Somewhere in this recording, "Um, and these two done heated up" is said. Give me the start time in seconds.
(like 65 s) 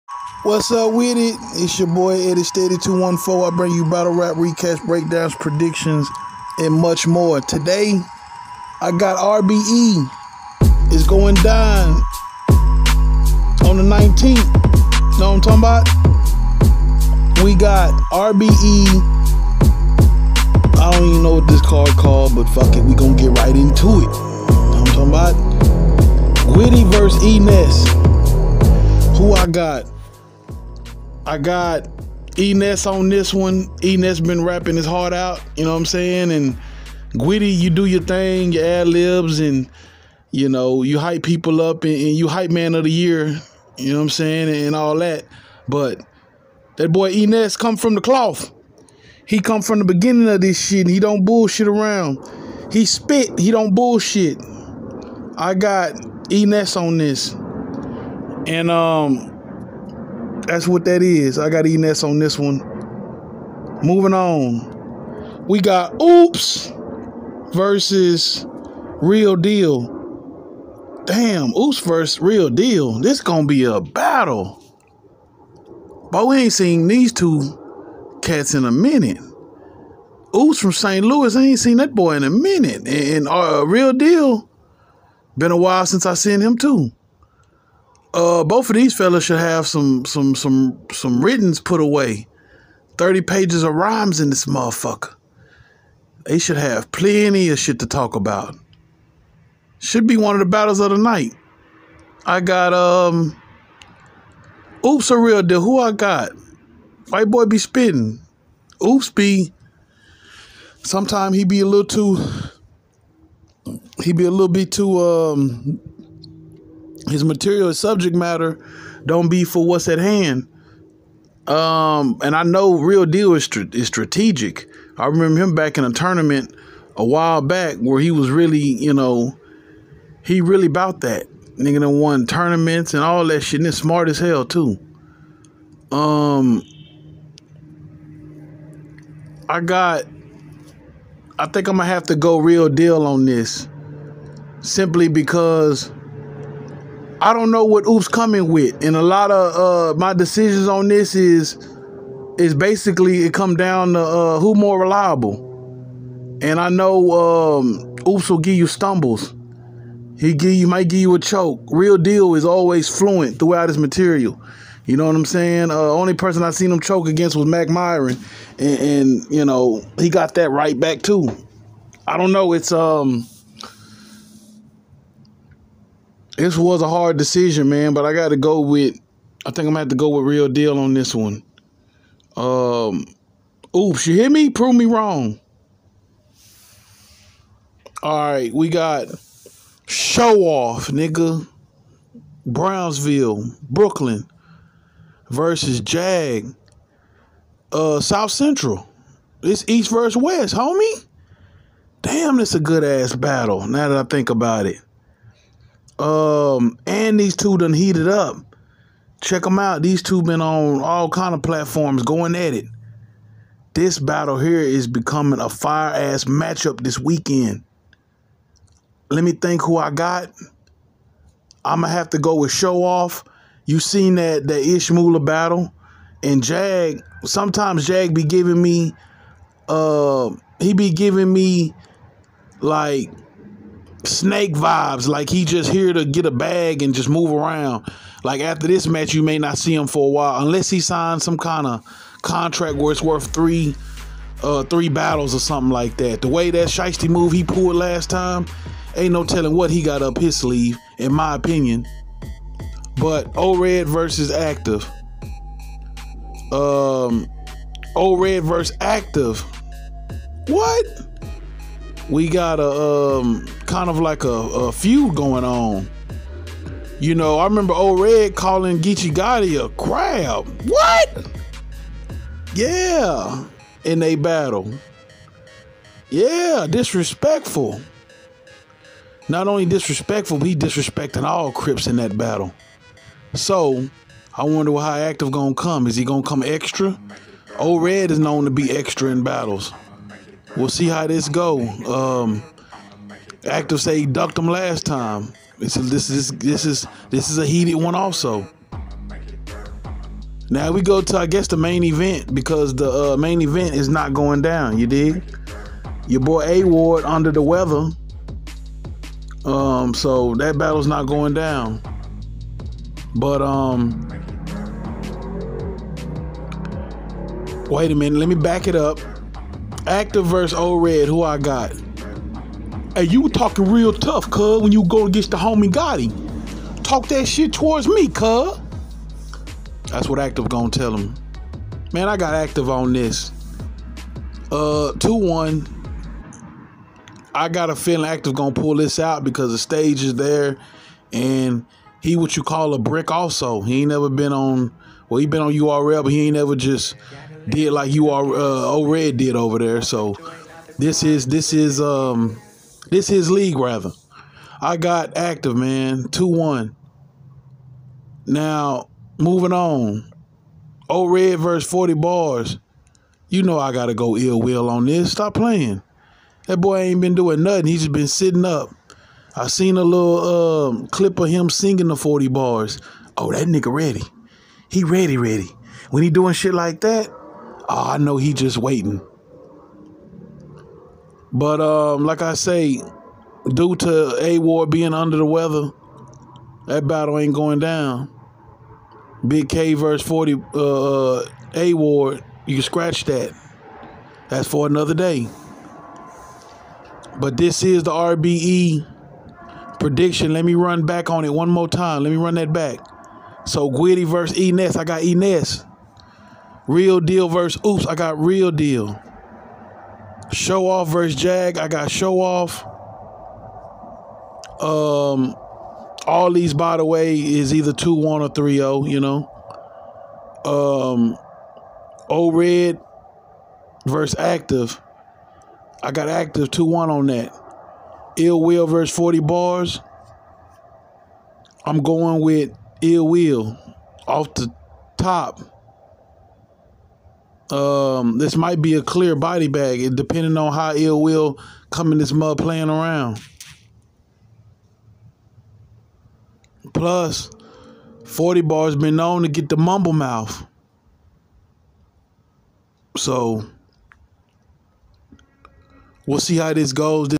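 206 s.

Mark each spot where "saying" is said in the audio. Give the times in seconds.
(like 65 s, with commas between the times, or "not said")
35 s, 44 s, 165 s.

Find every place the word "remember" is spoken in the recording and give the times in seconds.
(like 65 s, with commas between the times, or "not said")
125 s, 267 s.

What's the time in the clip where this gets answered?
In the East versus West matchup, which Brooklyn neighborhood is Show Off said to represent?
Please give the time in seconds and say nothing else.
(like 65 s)
192 s.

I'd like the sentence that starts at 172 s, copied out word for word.
It's um this was a hard decision, man, but I got to go with.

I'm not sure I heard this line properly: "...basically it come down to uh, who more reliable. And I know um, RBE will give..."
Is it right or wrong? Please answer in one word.
wrong.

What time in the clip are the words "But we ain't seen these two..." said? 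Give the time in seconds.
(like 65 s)
76 s.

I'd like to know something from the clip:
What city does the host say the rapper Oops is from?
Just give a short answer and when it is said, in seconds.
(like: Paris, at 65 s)
St. Louis, at 80 s.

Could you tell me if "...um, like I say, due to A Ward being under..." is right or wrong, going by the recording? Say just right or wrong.
right.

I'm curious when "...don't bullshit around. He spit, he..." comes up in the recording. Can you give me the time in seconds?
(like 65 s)
50 s.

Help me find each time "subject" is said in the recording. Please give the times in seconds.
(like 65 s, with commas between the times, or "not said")
117 s.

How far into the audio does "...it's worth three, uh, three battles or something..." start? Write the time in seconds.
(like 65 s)
242 s.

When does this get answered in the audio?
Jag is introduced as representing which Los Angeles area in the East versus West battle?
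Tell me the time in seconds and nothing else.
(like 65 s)
197 s.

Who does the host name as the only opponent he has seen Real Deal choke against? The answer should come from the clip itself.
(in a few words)
Mac Myron.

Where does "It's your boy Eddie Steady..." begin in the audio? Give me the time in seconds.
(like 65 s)
1 s.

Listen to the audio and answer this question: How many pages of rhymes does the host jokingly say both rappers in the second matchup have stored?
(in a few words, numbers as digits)
30.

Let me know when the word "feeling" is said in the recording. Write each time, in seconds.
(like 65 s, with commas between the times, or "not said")
337 s.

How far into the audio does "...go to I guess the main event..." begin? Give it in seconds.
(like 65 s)
300 s.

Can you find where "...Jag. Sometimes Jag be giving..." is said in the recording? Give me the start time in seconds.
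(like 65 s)
226 s.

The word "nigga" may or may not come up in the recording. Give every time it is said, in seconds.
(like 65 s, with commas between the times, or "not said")
131 s, 190 s, 373 s.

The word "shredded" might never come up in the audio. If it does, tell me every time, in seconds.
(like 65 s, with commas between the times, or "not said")
not said.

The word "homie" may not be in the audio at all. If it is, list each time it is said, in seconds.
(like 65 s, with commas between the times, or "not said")
200 s, 325 s.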